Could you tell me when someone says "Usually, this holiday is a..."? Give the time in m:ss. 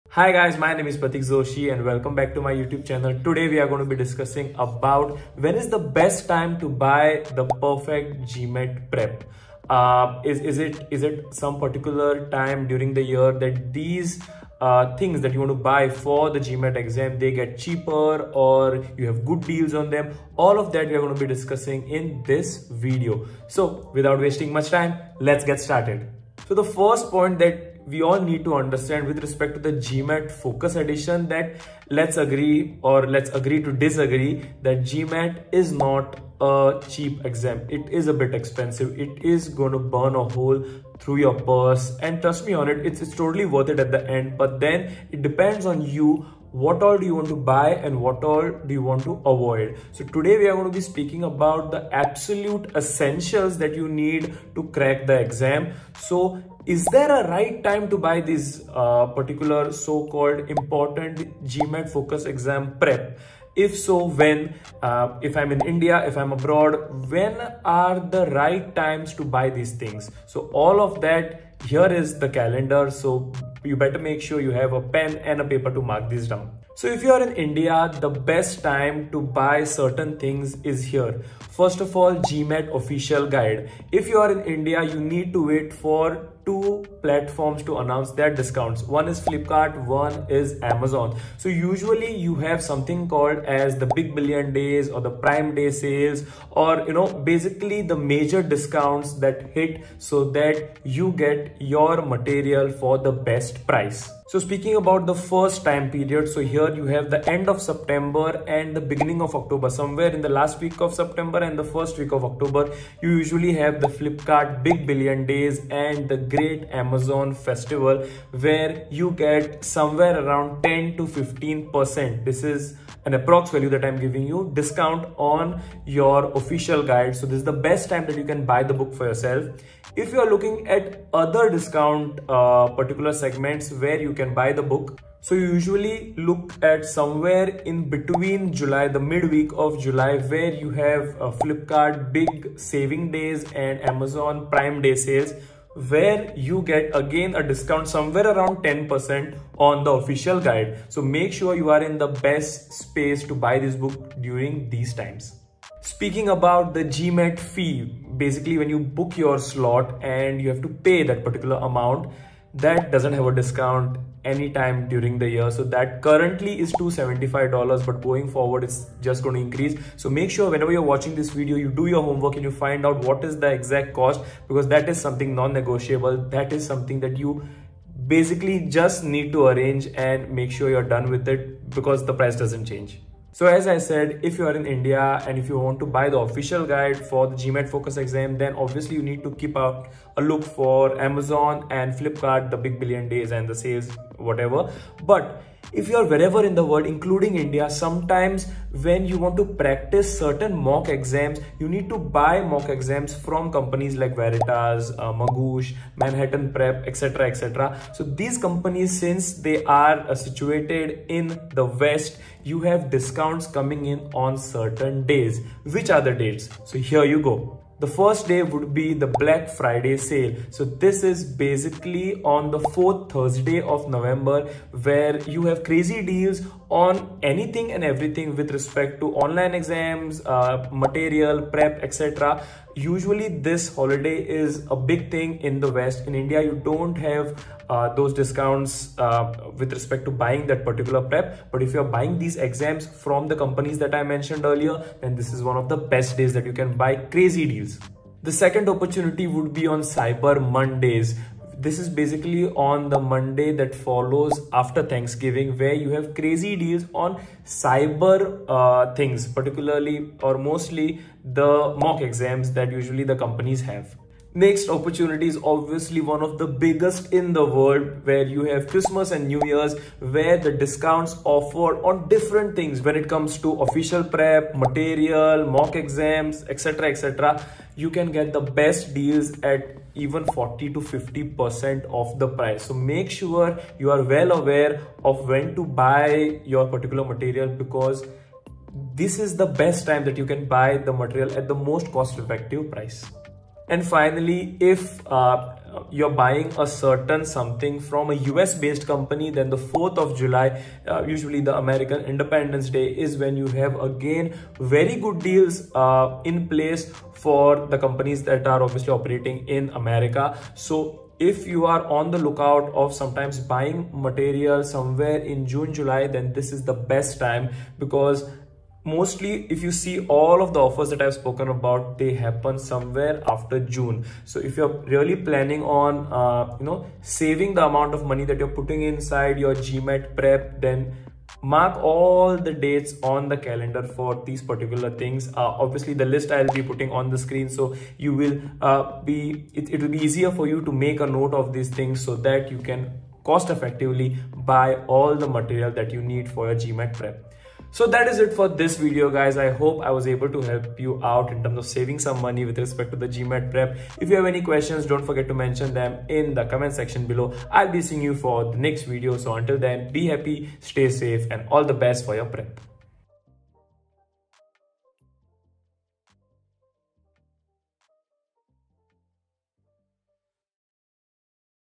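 3:52.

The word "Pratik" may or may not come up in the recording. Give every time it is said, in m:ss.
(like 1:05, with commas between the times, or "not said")
0:00.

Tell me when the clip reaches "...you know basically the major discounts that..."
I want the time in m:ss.
1:36.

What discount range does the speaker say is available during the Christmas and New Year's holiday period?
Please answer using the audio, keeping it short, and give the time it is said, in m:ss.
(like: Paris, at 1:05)
40 to 50%, at 4:40.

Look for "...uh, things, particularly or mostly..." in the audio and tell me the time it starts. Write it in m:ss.
4:18.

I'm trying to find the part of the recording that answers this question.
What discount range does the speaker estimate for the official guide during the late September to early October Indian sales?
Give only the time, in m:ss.
2:00.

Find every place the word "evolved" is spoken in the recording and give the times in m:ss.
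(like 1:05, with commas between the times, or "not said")
not said.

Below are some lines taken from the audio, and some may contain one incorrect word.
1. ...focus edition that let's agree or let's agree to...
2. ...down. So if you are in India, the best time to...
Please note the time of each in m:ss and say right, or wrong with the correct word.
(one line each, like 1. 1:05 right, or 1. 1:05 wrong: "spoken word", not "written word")
1. 0:30 right
2. 1:16 right.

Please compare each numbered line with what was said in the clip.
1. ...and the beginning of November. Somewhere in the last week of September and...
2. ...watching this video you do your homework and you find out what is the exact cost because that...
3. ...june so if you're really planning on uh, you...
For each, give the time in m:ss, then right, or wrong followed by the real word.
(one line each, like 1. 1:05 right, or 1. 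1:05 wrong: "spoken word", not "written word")
1. 1:48 wrong: "October", not "November"
2. 2:50 right
3. 5:23 right.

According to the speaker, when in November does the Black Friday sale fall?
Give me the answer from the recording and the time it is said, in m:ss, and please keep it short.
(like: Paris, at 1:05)
fourth Thursday, at 3:42.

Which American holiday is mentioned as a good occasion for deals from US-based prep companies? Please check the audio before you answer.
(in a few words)
4th of July.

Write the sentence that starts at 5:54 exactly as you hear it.
If you have any questions, don't forget to mention them in the comment section below.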